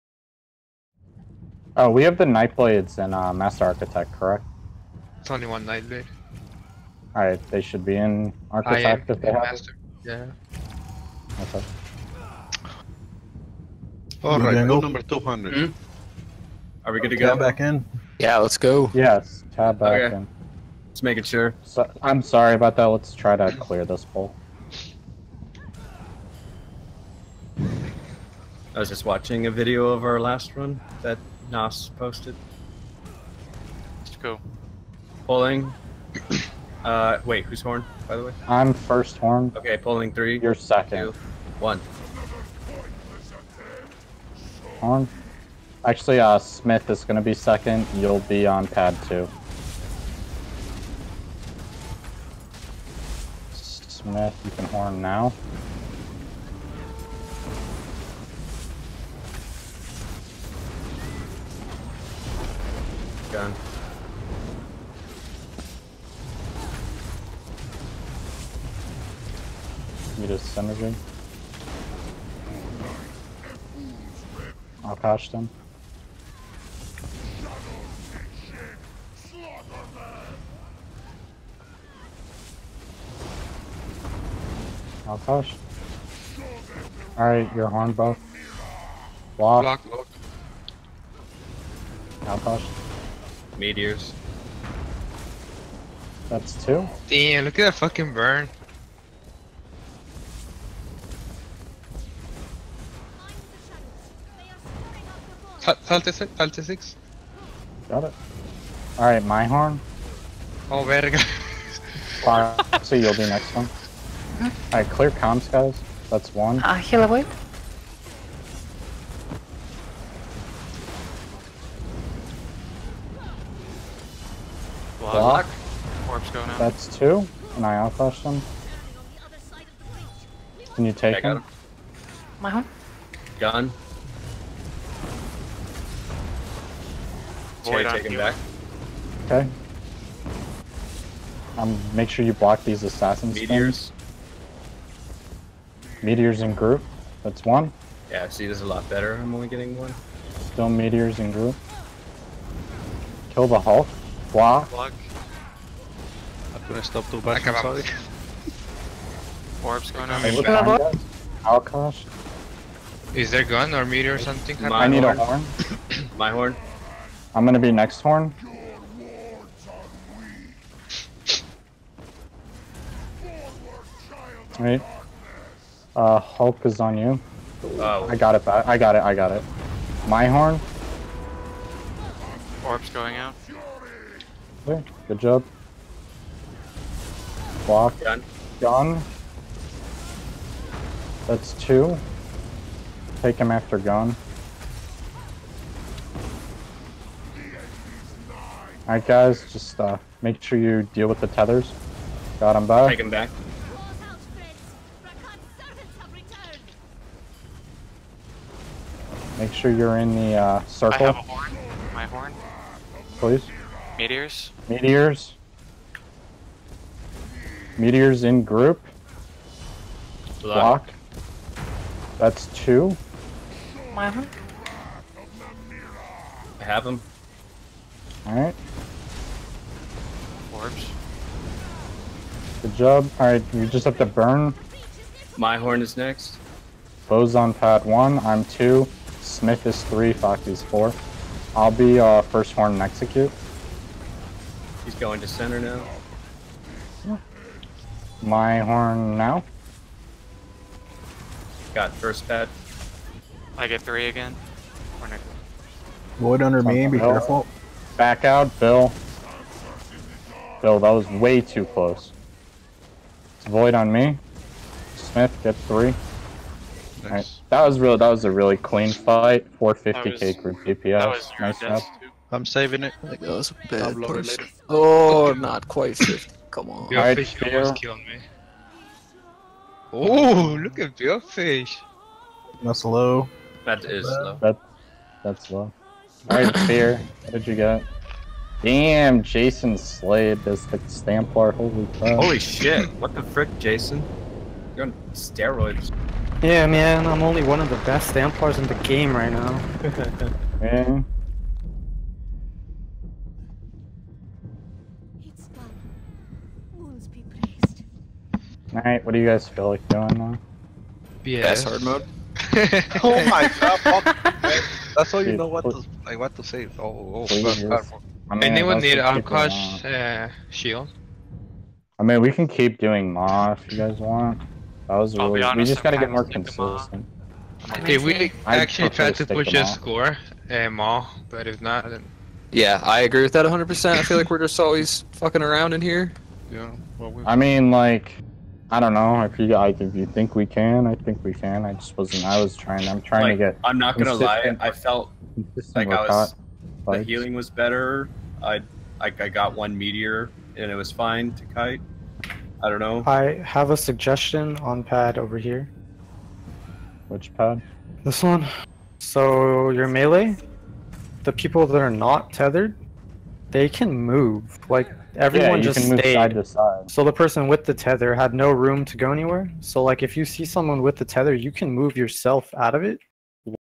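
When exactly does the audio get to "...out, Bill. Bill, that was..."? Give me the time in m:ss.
4:18.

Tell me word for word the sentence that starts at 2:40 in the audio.
Hey, behind us, Is there gun or meteor or something?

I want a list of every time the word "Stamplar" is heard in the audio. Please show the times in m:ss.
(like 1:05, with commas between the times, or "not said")
4:50, 4:58.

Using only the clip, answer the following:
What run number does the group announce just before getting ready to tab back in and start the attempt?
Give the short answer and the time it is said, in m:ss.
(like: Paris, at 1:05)
200, at 0:14.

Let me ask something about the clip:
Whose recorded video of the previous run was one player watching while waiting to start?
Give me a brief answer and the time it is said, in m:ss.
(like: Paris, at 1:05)
Nas, at 0:31.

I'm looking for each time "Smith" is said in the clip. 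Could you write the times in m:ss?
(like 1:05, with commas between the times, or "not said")
0:46, 0:53, 3:59, 4:24.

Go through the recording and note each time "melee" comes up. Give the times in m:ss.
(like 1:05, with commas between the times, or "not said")
5:59.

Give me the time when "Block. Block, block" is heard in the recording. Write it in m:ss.
1:29.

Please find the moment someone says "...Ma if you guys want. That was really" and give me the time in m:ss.
5:23.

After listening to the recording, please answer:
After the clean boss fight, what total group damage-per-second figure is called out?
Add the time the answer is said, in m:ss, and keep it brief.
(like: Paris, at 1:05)
450k, at 4:29.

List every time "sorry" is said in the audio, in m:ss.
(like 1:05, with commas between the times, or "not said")
0:22, 2:37.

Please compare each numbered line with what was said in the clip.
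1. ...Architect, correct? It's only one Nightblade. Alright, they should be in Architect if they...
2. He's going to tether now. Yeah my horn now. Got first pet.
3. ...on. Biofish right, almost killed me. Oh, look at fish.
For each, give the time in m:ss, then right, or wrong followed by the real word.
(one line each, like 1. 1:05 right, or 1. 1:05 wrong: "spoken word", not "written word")
1. 0:03 right
2. 4:04 wrong: "center", not "tether"
3. 4:36 right.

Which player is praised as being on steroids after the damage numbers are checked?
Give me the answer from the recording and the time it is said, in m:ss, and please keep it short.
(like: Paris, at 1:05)
Jason Slade, at 4:49.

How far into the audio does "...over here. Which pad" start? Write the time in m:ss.
5:55.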